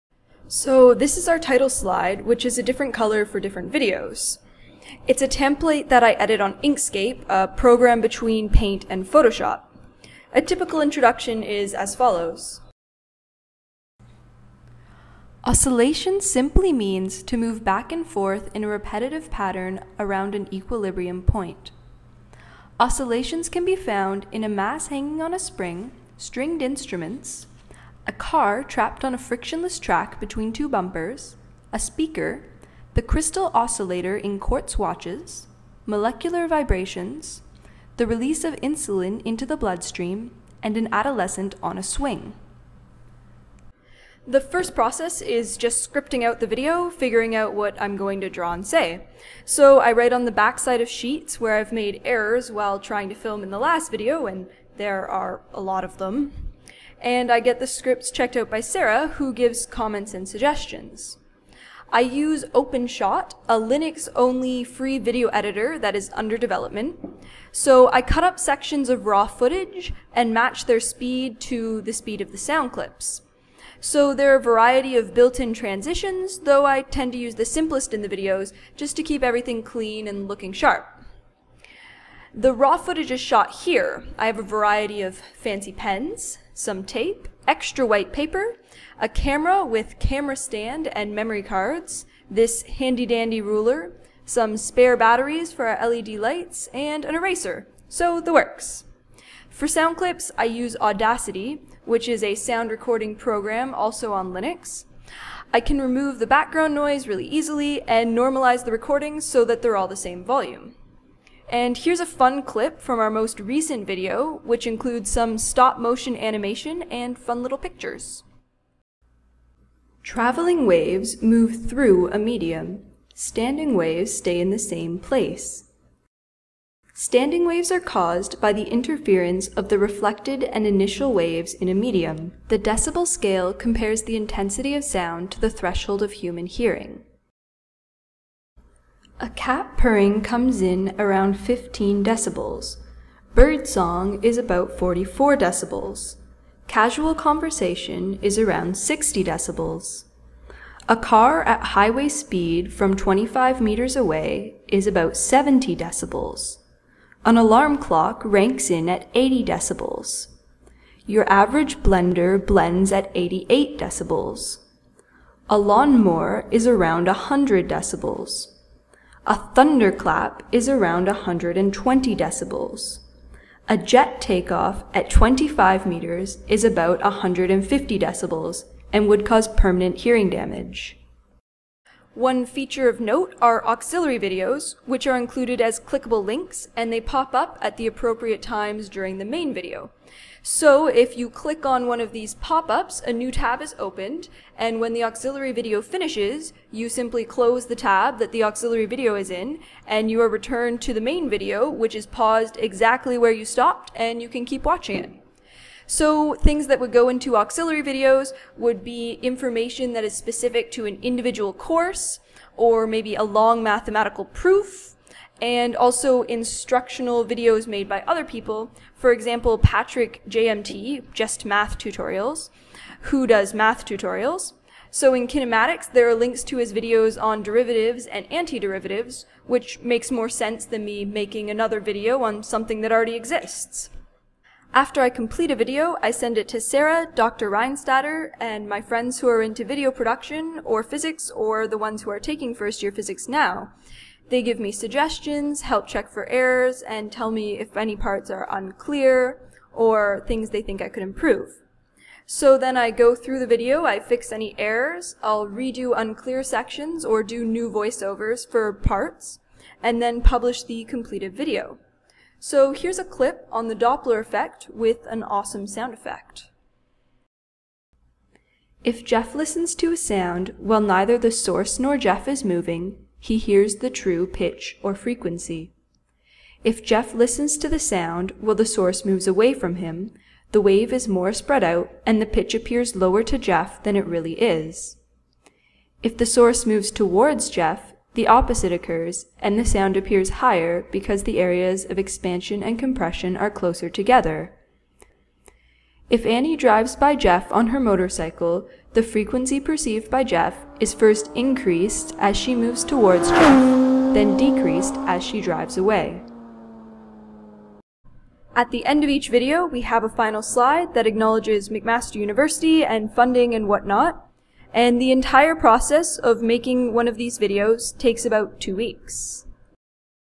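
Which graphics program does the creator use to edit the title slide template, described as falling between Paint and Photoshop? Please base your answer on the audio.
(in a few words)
Inkscape.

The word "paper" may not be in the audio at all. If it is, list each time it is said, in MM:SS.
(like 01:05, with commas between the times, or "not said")
01:28.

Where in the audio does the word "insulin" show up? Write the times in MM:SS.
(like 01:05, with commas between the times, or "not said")
00:38.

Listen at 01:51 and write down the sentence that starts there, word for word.
And here's a fun clip from our most recent video, which includes some stop motion animation and fun little pictures.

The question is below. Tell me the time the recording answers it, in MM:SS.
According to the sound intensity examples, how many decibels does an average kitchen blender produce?
02:43.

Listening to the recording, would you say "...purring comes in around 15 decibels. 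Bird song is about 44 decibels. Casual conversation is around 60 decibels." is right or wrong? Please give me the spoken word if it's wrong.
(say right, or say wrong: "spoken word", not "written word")
right.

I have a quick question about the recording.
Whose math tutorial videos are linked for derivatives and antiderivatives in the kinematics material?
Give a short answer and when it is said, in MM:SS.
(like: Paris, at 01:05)
Patrick JMT, at 03:39.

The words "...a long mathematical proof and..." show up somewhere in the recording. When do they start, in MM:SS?
03:33.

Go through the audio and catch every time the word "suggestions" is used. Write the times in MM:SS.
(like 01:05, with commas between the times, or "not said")
01:00, 04:04.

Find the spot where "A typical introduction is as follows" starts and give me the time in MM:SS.
00:10.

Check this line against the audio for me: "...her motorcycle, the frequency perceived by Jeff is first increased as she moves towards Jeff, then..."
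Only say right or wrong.
right.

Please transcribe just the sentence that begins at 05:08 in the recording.
At the end of each video, we have a final slide that acknowledges McMaster University and funding and whatnot.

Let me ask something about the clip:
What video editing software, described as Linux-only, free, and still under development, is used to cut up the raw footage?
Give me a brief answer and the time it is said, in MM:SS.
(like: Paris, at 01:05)
OpenShot, at 01:02.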